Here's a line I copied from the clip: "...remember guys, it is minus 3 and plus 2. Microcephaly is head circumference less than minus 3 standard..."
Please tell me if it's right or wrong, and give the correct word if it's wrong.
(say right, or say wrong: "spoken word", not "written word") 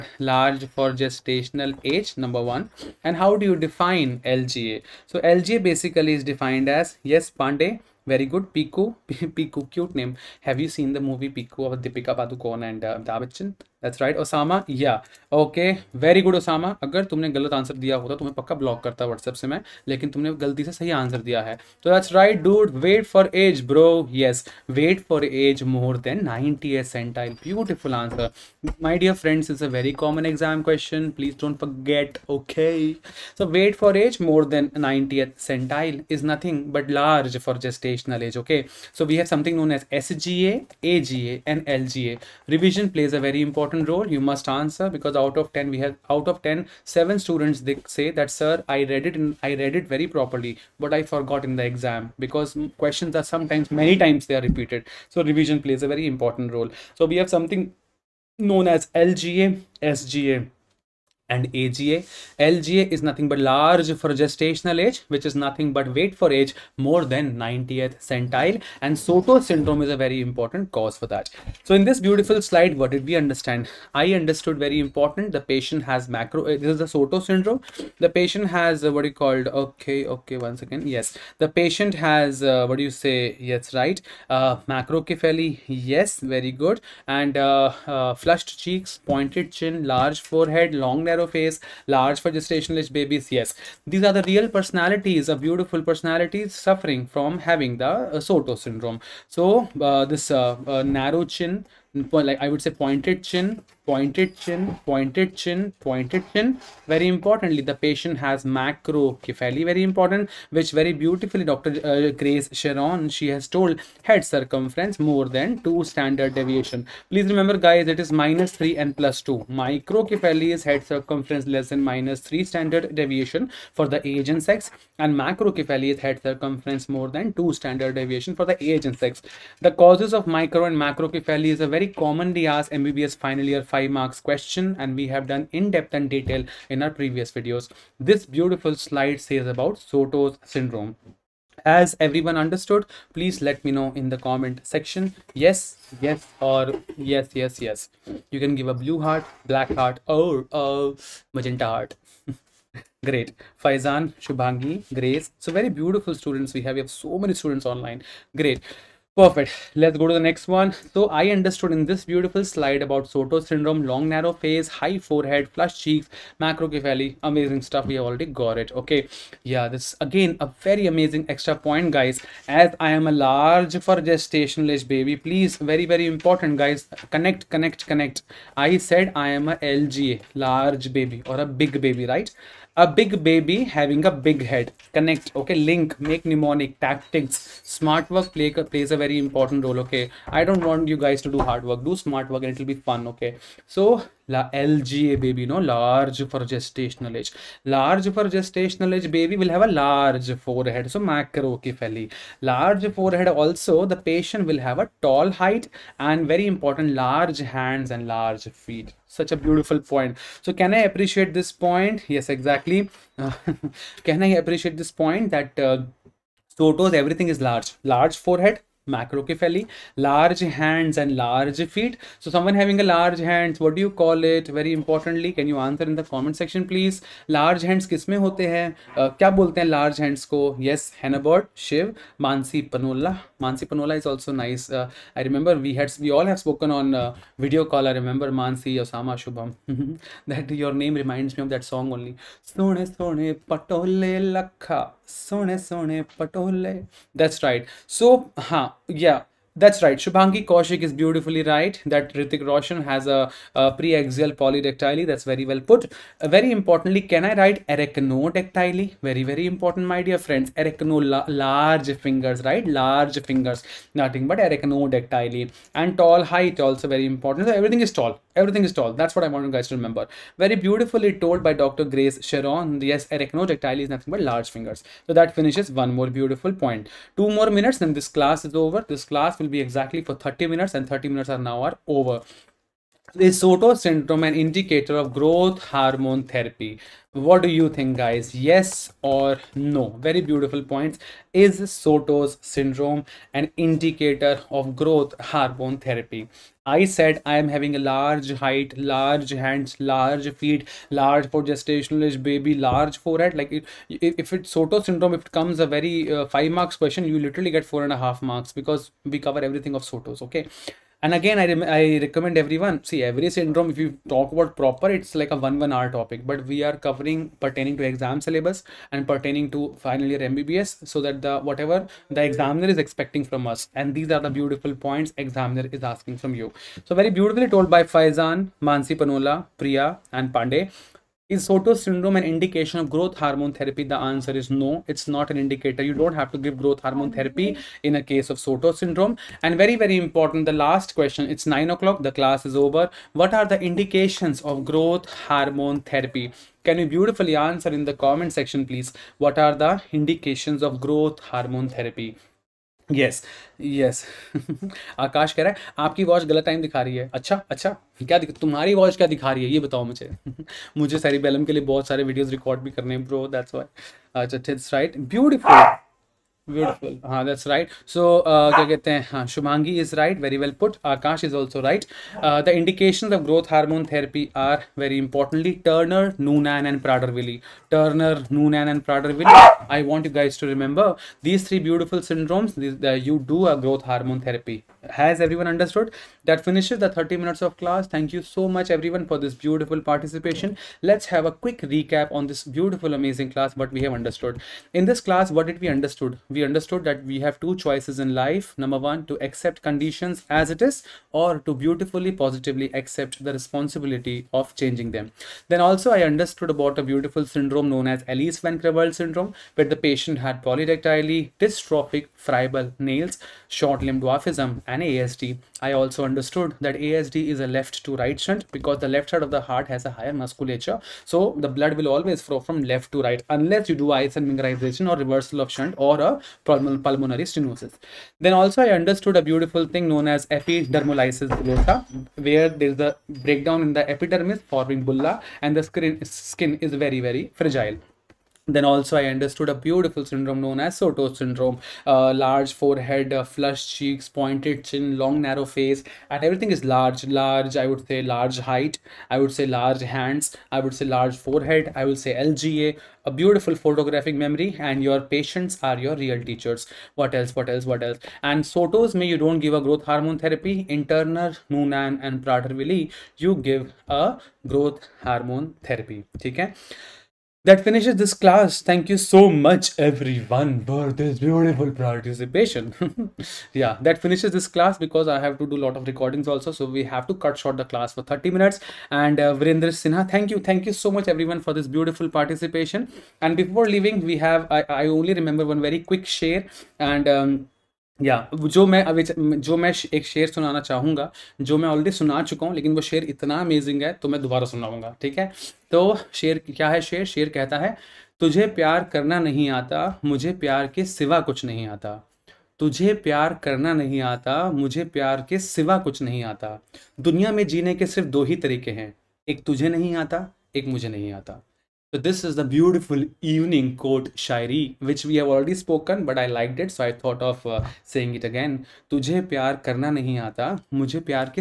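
right.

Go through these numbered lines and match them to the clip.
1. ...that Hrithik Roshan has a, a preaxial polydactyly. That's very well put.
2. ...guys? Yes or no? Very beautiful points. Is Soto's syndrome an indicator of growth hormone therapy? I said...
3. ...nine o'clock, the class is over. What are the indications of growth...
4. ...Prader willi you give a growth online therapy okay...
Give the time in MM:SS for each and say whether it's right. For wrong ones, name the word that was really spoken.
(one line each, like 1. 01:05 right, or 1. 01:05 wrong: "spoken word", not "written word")
1. 04:11 right
2. 04:47 right
3. 05:41 right
4. 07:42 wrong: "hormone", not "online".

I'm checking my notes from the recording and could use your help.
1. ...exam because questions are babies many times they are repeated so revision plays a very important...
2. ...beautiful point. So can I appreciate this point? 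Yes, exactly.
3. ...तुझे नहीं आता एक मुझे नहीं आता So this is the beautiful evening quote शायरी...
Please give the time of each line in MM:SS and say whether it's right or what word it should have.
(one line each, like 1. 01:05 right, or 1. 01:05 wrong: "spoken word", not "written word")
1. 00:51 wrong: "sometimes", not "babies"
2. 03:29 right
3. 08:29 right.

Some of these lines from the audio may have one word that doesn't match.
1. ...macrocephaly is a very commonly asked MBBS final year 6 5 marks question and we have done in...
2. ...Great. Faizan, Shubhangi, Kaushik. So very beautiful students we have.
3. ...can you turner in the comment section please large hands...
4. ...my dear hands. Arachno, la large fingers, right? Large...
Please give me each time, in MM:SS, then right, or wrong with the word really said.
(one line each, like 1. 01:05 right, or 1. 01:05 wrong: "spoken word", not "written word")
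1. 02:10 wrong: "5", not "6"
2. 02:33 wrong: "Grace", not "Kaushik"
3. 03:45 wrong: "answer", not "turner"
4. 04:19 wrong: "friends", not "hands".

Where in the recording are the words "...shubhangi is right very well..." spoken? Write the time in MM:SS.
06:09.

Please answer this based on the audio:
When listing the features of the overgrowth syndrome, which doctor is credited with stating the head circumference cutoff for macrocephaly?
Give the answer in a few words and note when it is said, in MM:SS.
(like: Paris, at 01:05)
Dr. Grace Sharon, at 01:51.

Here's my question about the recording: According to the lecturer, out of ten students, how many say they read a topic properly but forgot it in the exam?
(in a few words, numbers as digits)
7.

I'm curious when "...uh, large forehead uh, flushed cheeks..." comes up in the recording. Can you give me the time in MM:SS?
07:21.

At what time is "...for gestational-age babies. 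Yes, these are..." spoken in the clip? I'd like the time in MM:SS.
01:32.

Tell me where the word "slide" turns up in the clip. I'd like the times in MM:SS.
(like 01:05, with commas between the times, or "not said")
01:12, 02:18, 02:42.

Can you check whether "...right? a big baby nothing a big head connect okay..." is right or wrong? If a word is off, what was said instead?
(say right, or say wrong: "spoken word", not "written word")
wrong: "having", not "nothing".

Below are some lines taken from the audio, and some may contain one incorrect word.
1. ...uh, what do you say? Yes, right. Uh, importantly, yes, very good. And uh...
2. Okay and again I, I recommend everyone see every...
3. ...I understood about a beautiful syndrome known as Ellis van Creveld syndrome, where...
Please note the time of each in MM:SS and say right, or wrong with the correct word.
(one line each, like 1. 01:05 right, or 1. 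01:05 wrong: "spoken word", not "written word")
1. 01:22 wrong: "macrocephaly", not "importantly"
2. 05:10 right
3. 06:45 right.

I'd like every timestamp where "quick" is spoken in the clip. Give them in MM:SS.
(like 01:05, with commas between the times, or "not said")
06:31, 08:05.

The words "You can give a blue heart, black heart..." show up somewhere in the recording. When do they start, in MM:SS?
02:28.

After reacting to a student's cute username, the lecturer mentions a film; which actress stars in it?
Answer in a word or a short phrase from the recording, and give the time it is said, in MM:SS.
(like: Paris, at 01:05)
Deepika Padukone, at 00:11.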